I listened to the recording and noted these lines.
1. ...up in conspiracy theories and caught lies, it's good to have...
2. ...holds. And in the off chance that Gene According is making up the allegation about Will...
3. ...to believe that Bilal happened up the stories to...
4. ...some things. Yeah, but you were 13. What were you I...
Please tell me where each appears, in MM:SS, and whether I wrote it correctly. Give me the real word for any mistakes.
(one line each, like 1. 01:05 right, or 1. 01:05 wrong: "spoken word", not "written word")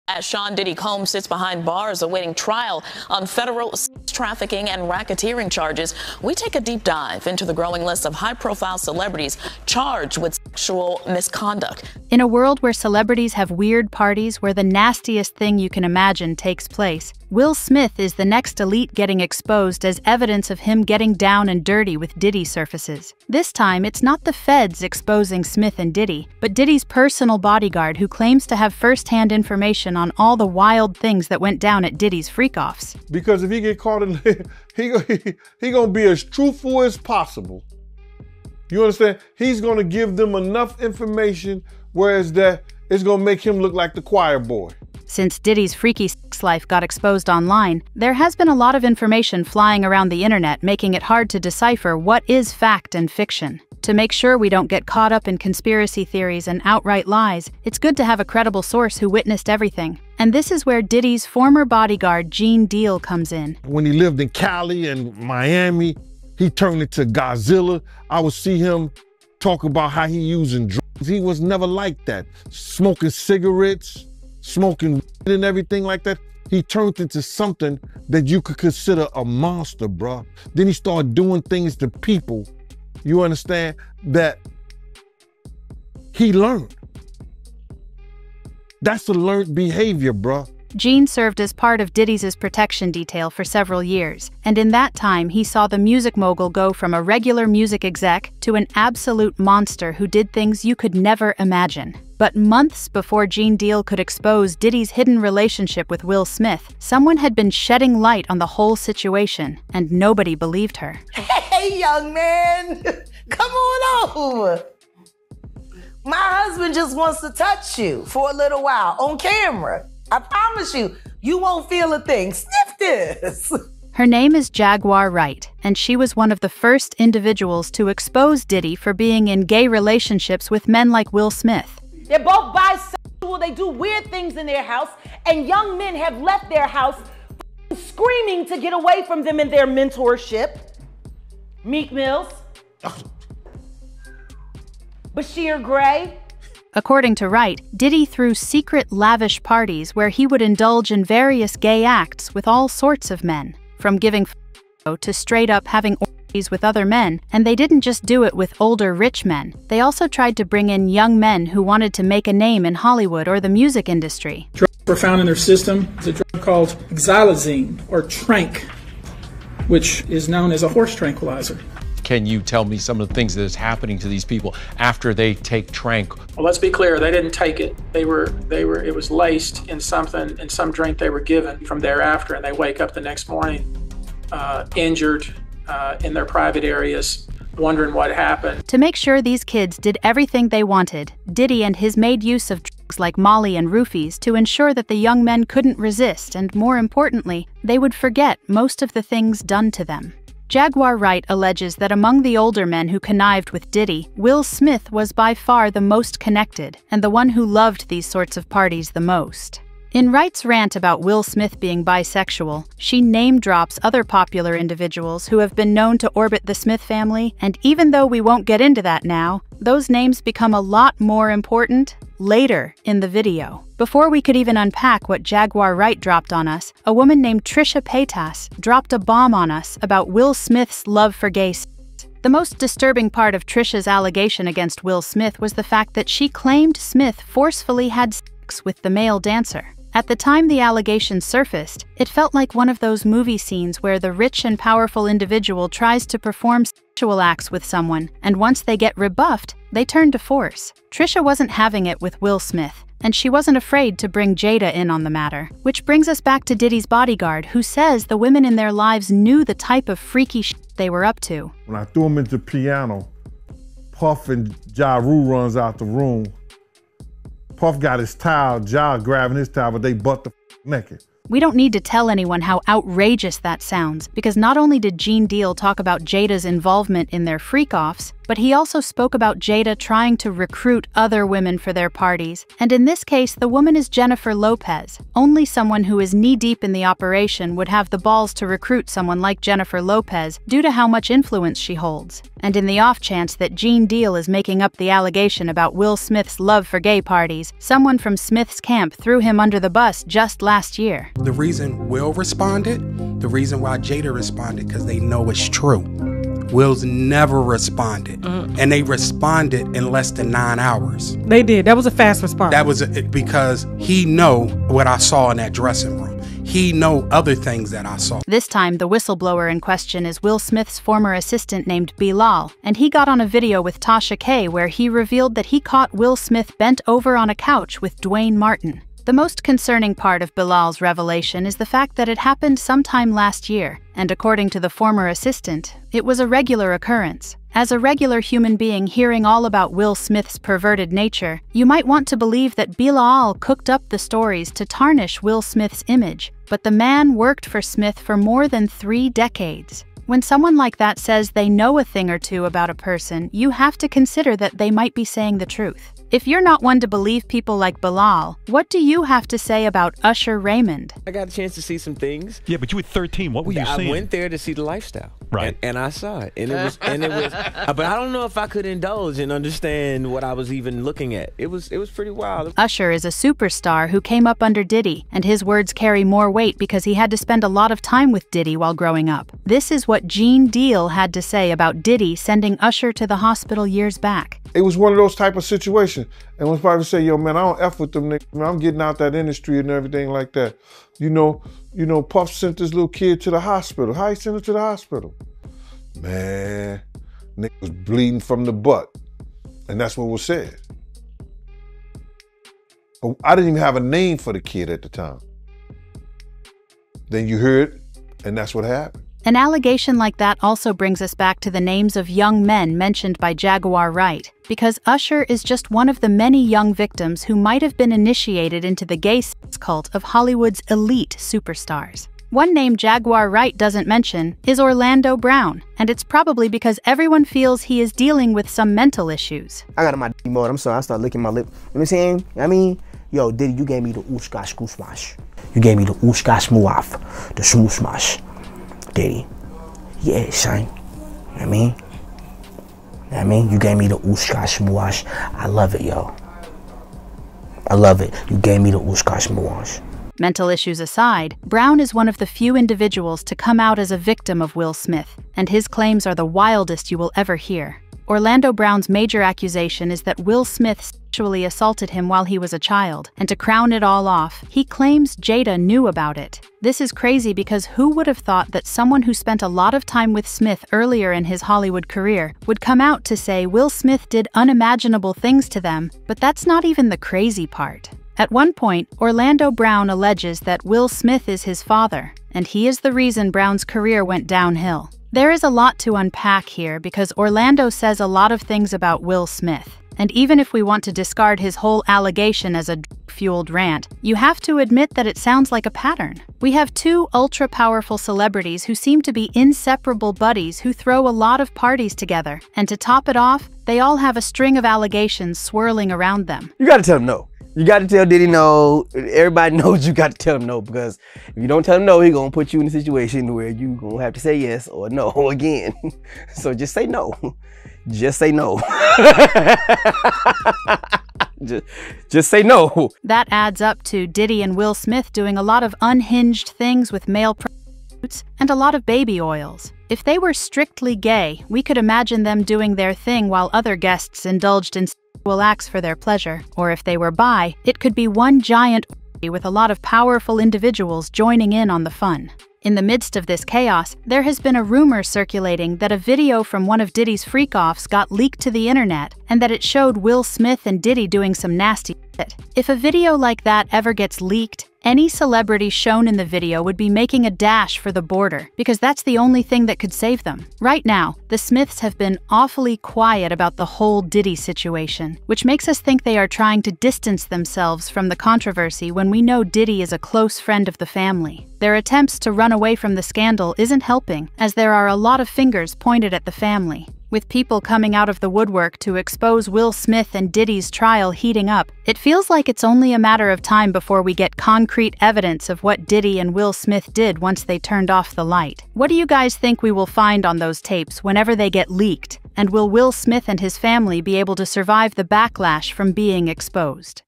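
1. 00:55 wrong: "outright", not "caught"
2. 04:51 wrong: "Deal", not "According"
3. 05:42 wrong: "cooked", not "happened"
4. 06:01 right.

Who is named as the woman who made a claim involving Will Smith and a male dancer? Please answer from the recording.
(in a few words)
Trisha Paytas.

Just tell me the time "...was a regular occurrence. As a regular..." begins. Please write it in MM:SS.
05:36.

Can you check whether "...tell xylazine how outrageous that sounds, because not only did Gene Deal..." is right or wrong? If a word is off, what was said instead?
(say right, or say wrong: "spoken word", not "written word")
wrong: "anyone", not "xylazine".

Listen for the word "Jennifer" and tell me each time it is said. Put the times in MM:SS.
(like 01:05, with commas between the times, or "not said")
04:43, 04:49.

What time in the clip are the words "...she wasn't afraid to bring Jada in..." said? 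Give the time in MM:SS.
04:13.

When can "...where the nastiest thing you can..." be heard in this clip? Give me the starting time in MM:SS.
00:14.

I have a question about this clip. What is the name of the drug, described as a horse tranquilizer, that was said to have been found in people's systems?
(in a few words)
Xylazine.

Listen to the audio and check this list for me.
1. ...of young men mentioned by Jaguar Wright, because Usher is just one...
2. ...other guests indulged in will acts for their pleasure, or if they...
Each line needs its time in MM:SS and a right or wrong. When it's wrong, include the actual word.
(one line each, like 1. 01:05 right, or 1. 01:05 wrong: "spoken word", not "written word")
1. 06:51 right
2. 08:53 right.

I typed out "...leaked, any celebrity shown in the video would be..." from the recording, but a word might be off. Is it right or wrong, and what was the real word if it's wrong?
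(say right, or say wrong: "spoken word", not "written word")
right.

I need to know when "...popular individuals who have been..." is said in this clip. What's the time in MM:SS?
03:34.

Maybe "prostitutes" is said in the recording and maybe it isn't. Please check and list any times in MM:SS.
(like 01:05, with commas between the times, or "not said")
08:47.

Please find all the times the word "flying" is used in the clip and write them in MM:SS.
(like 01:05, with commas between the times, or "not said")
00:49.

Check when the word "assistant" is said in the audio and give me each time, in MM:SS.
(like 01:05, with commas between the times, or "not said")
05:21, 05:35.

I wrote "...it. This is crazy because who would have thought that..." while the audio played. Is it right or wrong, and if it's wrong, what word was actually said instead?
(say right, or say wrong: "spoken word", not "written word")
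right.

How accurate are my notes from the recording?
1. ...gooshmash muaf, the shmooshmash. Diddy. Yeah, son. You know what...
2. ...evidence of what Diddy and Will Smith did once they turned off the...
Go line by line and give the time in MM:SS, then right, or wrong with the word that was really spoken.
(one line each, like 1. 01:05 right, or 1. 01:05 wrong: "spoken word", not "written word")
1. 07:15 wrong: "ooshkash", not "gooshmash"
2. 09:45 right.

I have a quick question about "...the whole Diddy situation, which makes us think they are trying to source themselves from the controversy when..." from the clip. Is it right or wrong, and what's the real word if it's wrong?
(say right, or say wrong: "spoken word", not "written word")
wrong: "distance", not "source".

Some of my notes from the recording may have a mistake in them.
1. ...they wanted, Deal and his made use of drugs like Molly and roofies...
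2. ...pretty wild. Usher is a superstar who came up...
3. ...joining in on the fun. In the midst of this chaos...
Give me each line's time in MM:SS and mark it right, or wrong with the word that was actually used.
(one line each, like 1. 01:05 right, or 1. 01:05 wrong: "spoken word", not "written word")
1. 03:10 wrong: "Diddy", not "Deal"
2. 06:11 right
3. 09:01 right.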